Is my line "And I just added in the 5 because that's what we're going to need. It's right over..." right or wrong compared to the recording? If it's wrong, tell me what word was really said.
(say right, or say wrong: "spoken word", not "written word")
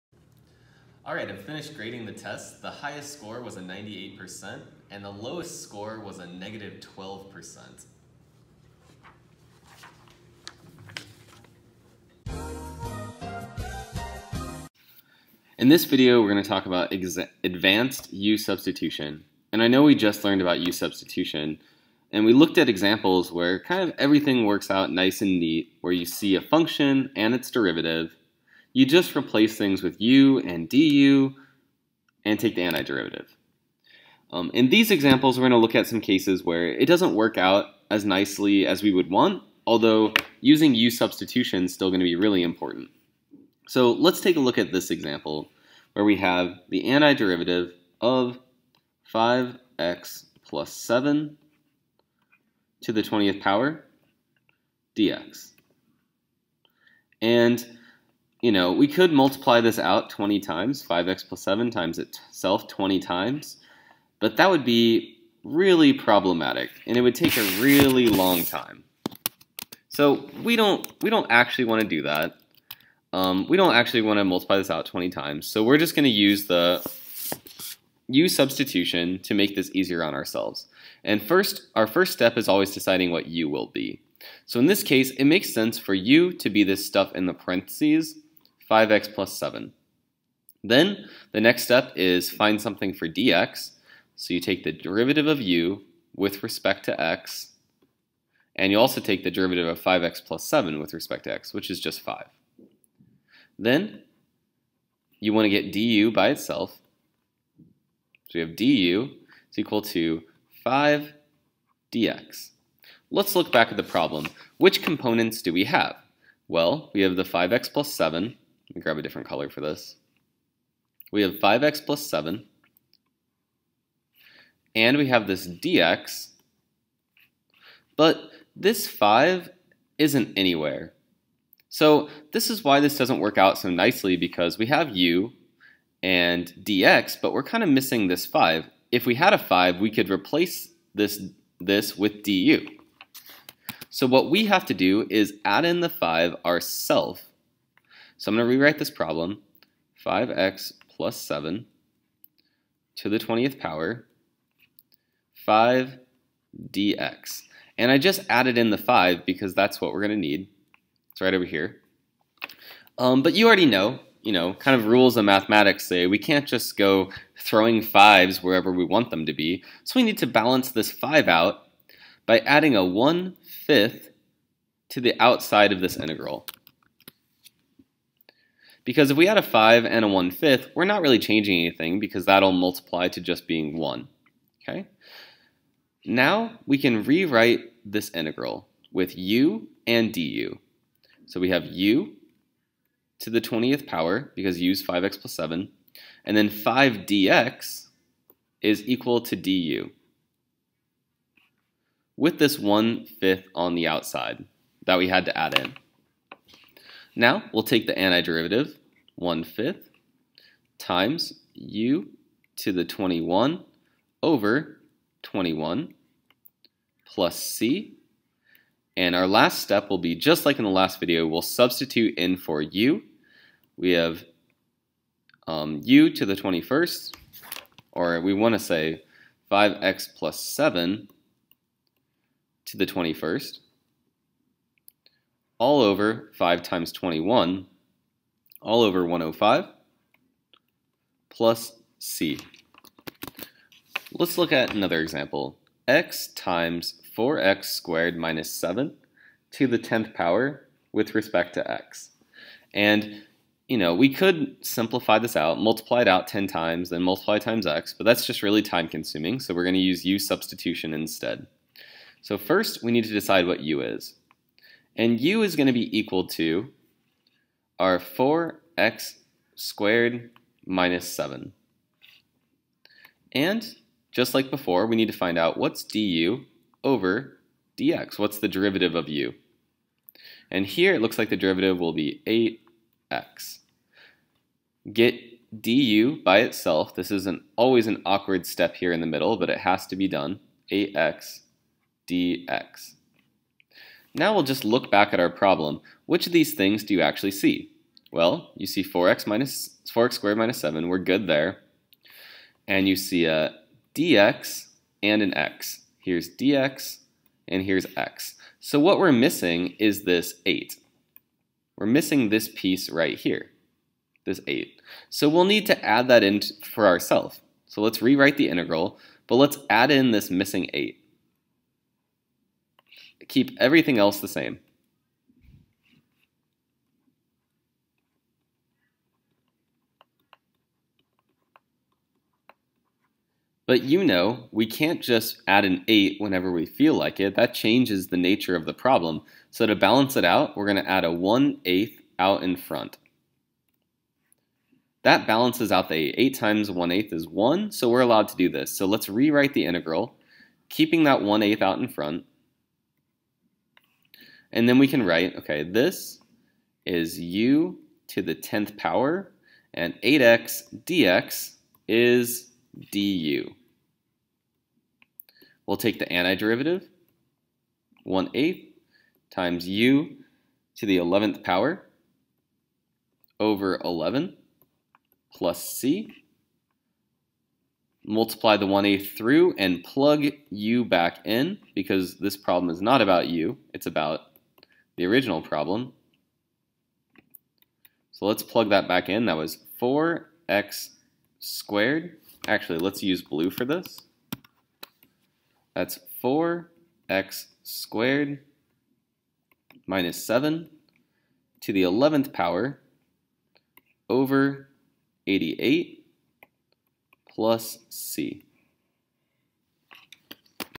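right.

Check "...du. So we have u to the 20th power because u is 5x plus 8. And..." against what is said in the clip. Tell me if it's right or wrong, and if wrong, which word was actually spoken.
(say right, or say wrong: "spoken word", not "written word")
wrong: "7", not "8".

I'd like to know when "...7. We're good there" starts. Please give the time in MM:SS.
05:00.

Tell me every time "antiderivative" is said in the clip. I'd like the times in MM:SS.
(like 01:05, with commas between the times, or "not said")
00:32, 00:46, 03:27, 06:06.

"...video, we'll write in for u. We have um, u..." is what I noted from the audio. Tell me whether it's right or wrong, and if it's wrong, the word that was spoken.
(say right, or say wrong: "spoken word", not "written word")
wrong: "substitute", not "write".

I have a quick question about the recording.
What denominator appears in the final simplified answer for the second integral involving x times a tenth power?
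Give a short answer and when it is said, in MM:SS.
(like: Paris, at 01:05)
88, at 06:45.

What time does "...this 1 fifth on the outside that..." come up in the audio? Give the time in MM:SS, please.
03:22.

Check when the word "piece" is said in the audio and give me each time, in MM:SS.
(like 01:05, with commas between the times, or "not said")
05:12.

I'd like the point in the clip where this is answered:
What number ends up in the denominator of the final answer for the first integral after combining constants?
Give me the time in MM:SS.
03:59.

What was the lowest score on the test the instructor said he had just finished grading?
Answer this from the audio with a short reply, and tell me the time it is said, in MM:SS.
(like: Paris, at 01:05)
-12%, at 00:06.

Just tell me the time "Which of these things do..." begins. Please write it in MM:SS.
04:56.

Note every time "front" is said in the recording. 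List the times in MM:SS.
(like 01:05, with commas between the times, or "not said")
05:42, 05:51.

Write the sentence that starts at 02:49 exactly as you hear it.
So we need to balance this 5 out by adding a 1 fifth to the outside of this integral.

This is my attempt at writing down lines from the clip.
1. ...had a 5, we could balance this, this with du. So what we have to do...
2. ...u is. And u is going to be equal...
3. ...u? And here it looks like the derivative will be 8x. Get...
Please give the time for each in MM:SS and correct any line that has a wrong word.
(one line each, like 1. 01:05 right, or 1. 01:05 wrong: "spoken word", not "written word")
1. 02:19 wrong: "replace", not "balance"
2. 04:23 right
3. 04:39 right.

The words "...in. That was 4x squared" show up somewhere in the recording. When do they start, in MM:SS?
06:29.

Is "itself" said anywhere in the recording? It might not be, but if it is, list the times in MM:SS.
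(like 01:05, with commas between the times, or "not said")
01:01, 01:46, 04:46.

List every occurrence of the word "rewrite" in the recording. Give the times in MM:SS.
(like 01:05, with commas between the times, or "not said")
02:28, 03:07, 05:18, 05:49.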